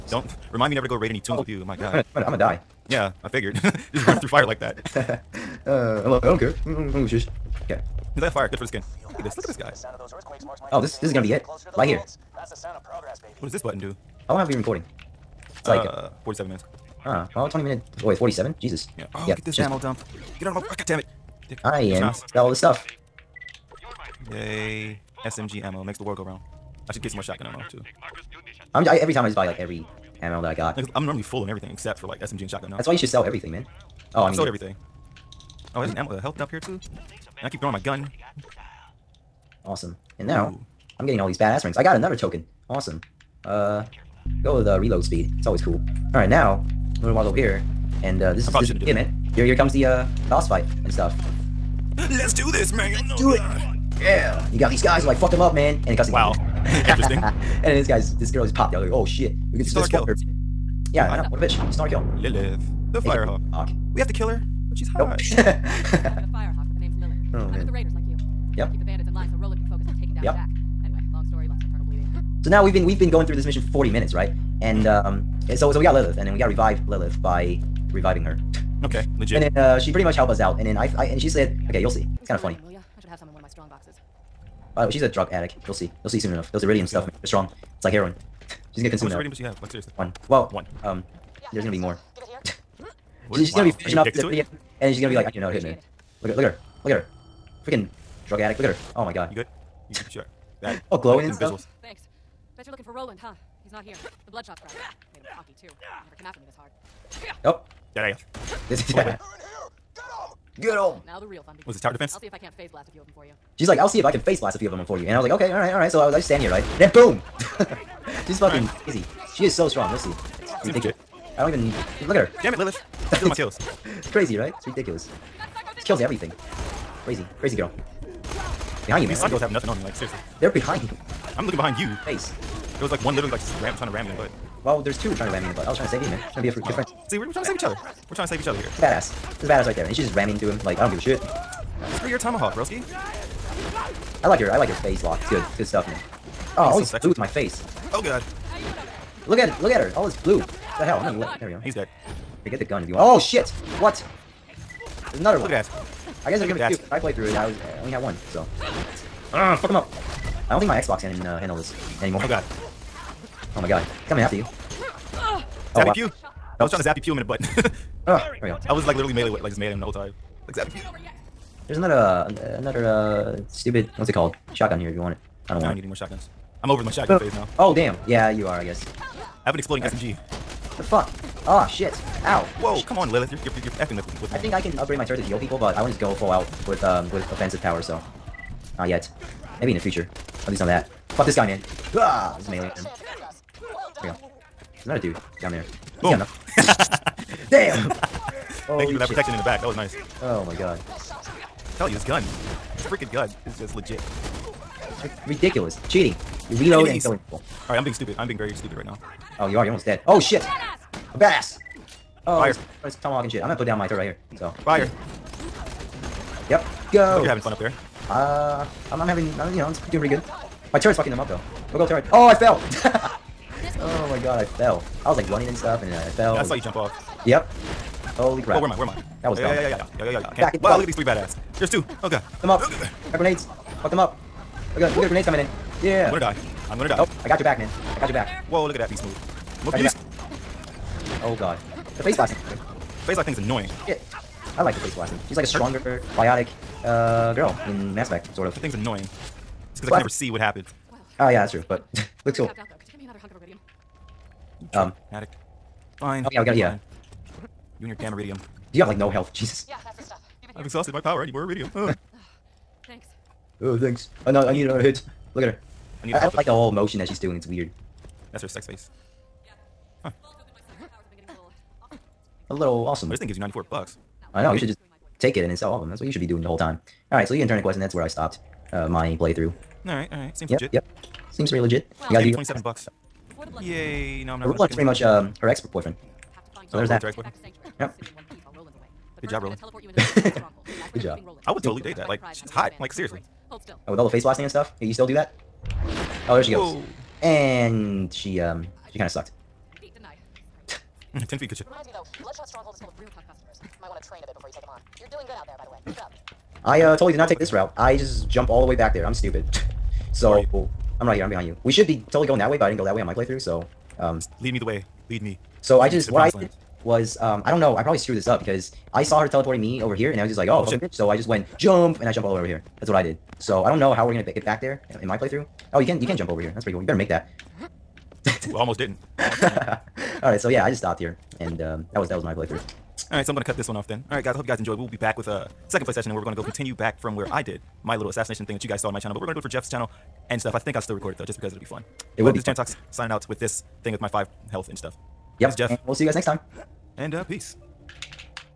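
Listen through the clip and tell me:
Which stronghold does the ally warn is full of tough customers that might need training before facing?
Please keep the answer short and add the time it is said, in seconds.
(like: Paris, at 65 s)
Bloodshot Stronghold, at 302 s.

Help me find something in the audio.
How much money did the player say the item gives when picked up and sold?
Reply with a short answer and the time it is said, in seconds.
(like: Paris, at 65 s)
94 bucks, at 273 s.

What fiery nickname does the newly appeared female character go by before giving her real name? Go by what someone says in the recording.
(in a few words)
The Firehawk.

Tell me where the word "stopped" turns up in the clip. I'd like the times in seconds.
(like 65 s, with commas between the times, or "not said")
278 s, 330 s.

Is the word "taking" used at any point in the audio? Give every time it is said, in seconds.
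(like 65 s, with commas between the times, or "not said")
69 s.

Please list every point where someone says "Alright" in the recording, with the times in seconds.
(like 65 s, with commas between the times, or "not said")
46 s, 207 s.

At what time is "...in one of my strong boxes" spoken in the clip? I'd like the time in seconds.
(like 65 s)
83 s.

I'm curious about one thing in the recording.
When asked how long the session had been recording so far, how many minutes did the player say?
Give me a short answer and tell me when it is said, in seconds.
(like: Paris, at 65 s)
47, at 16 s.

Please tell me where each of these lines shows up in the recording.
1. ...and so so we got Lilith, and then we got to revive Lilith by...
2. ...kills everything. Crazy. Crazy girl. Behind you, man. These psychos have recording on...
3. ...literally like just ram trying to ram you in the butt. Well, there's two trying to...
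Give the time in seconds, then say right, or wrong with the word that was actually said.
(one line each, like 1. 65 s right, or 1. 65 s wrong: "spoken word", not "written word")
1. 75 s right
2. 125 s wrong: "nothing", not "recording"
3. 133 s right.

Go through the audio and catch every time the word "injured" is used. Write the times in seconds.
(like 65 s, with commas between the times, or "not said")
not said.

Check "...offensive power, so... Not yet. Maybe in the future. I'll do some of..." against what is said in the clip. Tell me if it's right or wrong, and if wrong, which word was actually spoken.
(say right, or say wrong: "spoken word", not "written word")
right.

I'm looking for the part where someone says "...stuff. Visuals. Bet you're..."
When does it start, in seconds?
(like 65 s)
101 s.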